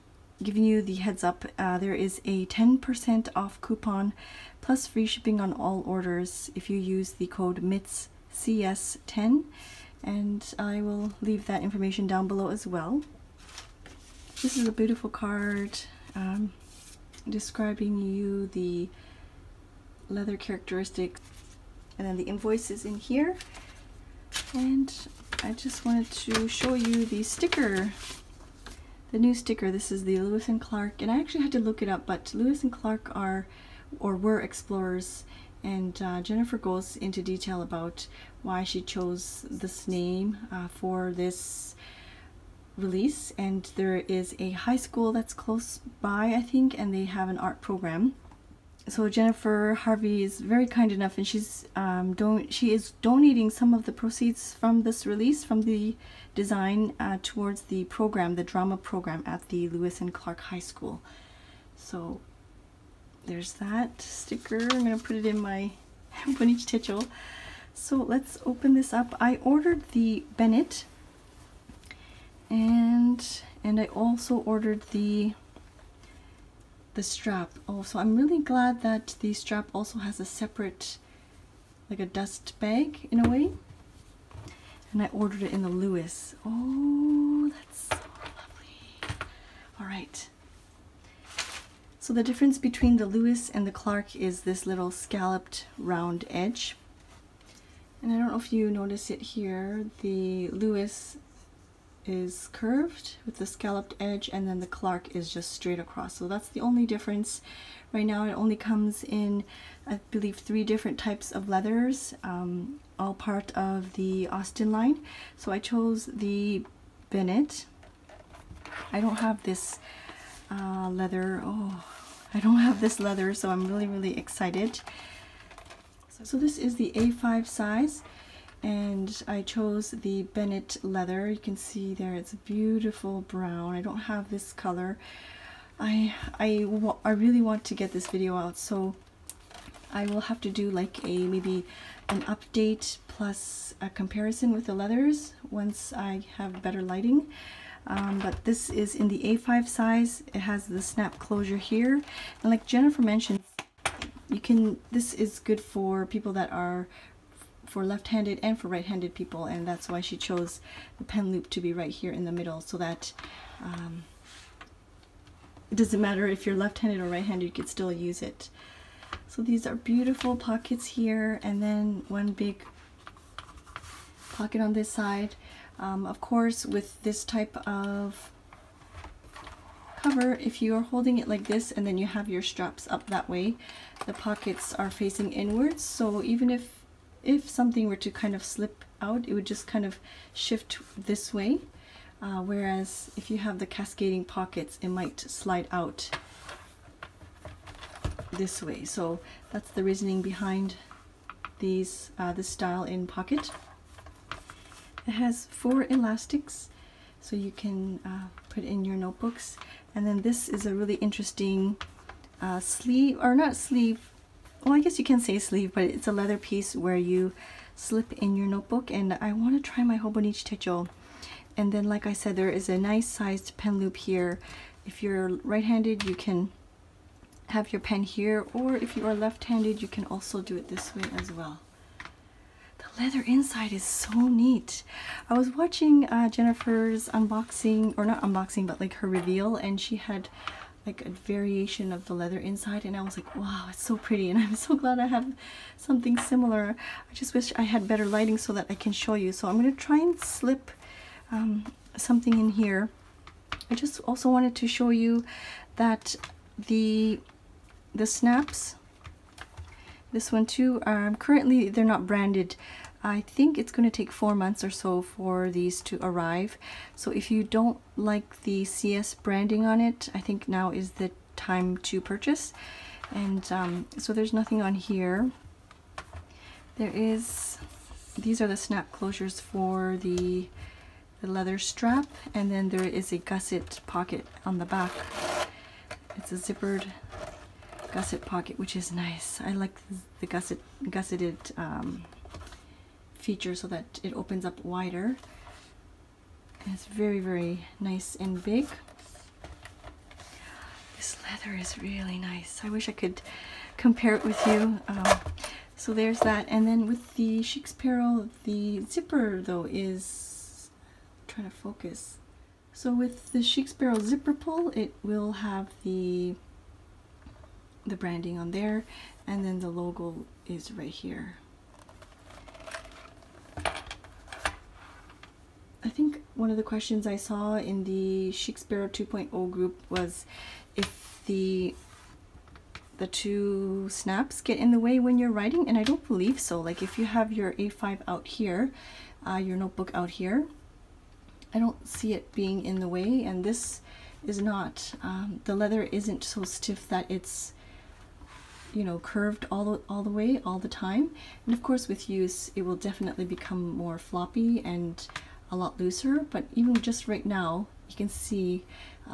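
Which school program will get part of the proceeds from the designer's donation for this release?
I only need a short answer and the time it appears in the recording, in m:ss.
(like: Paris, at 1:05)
Drama program, at 0:58.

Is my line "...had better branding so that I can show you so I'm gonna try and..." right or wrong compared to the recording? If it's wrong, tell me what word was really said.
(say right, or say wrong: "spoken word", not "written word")
wrong: "lighting", not "branding".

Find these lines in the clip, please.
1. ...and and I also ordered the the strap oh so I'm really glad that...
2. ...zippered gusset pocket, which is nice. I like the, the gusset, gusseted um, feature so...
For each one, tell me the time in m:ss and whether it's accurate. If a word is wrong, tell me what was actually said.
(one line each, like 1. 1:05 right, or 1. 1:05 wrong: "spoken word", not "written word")
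1. 1:12 right
2. 4:46 right.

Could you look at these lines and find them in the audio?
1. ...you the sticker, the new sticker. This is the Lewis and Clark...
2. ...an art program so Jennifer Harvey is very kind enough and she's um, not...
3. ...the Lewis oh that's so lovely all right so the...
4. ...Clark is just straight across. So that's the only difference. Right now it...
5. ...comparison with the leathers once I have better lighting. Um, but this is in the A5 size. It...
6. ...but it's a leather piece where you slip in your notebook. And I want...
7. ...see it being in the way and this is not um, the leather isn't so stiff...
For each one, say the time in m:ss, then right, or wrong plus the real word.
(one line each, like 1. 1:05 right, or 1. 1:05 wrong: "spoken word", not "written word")
1. 0:26 right
2. 0:47 right
3. 1:25 right
4. 1:44 right
5. 2:23 right
6. 3:35 right
7. 5:41 right.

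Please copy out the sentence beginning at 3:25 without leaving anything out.
It has four elastics, so you can uh, put in your notebooks.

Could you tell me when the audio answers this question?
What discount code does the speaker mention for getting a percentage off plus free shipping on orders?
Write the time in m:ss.
0:07.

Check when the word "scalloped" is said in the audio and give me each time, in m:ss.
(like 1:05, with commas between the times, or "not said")
1:34, 1:43.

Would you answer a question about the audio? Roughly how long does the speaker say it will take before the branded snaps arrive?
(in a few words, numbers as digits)
4 months.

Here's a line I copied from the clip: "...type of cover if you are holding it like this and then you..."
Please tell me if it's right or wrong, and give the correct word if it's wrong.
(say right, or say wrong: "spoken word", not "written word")
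right.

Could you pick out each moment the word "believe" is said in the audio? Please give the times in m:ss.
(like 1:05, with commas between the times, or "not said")
1:50, 5:36.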